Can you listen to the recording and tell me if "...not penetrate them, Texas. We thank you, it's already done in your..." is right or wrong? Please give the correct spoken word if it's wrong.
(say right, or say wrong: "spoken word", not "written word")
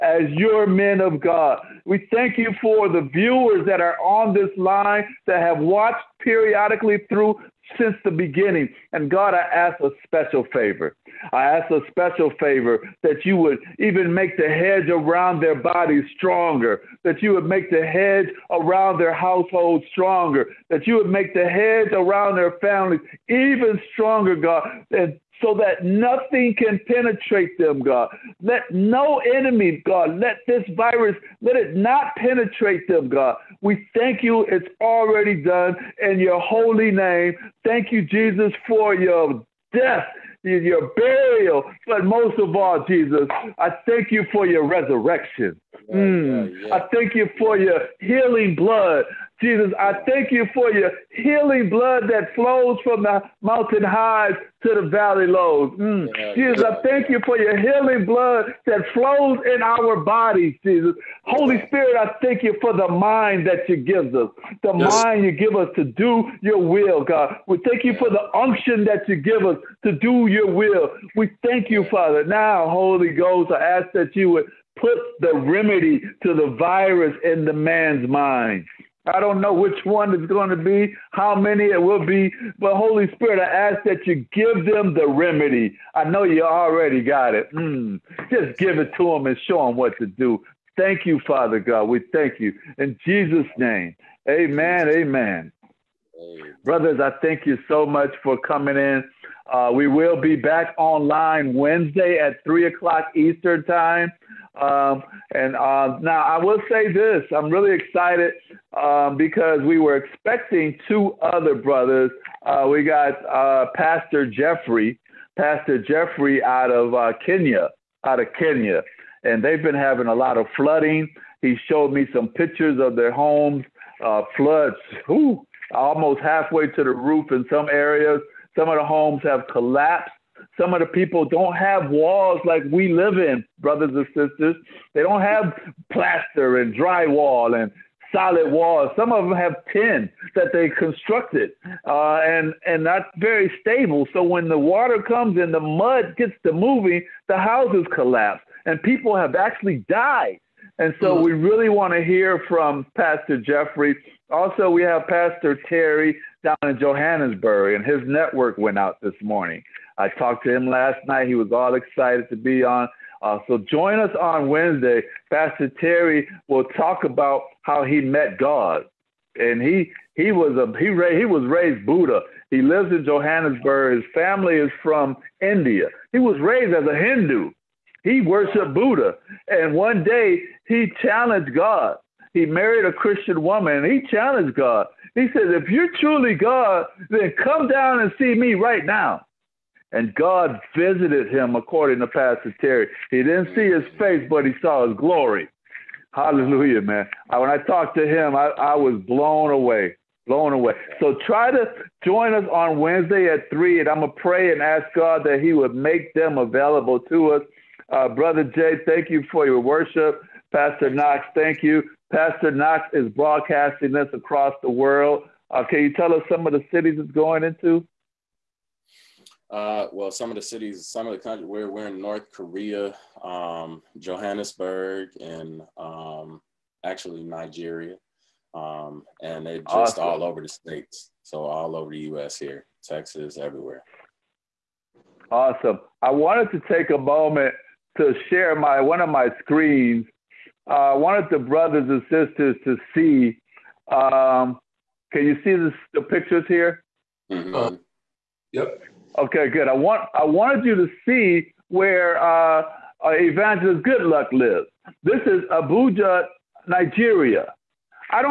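wrong: "God", not "Texas".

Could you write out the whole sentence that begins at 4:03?
Um, can you see this, the pictures here?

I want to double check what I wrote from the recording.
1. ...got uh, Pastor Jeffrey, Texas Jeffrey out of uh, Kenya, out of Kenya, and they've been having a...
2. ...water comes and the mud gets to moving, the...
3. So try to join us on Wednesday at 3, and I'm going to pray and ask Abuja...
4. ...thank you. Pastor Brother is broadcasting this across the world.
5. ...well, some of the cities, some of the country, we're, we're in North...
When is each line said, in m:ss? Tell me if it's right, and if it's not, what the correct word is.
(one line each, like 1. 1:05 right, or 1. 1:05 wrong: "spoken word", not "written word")
1. 1:52 wrong: "Pastor", not "Texas"
2. 2:24 right
3. 3:20 wrong: "God", not "Abuja"
4. 3:31 wrong: "Knox", not "Brother"
5. 3:39 right.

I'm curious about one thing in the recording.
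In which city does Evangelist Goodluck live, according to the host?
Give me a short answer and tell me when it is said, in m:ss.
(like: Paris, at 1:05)
Abuja, Nigeria, at 4:15.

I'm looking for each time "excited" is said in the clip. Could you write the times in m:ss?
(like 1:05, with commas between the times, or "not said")
1:47, 2:41.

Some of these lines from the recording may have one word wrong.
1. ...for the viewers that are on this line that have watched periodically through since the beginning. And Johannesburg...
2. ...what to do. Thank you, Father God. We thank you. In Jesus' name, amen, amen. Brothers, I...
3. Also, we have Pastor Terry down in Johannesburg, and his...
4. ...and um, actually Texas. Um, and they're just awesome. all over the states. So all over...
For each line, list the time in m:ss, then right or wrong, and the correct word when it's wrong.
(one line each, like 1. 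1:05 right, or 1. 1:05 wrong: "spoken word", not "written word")
1. 0:02 wrong: "God", not "Johannesburg"
2. 1:29 right
3. 2:34 right
4. 3:45 wrong: "Nigeria", not "Texas".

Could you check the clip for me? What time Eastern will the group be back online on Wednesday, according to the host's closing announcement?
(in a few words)
3 o'clock.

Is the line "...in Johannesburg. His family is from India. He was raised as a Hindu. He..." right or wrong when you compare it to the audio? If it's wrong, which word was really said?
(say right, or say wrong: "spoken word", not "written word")
right.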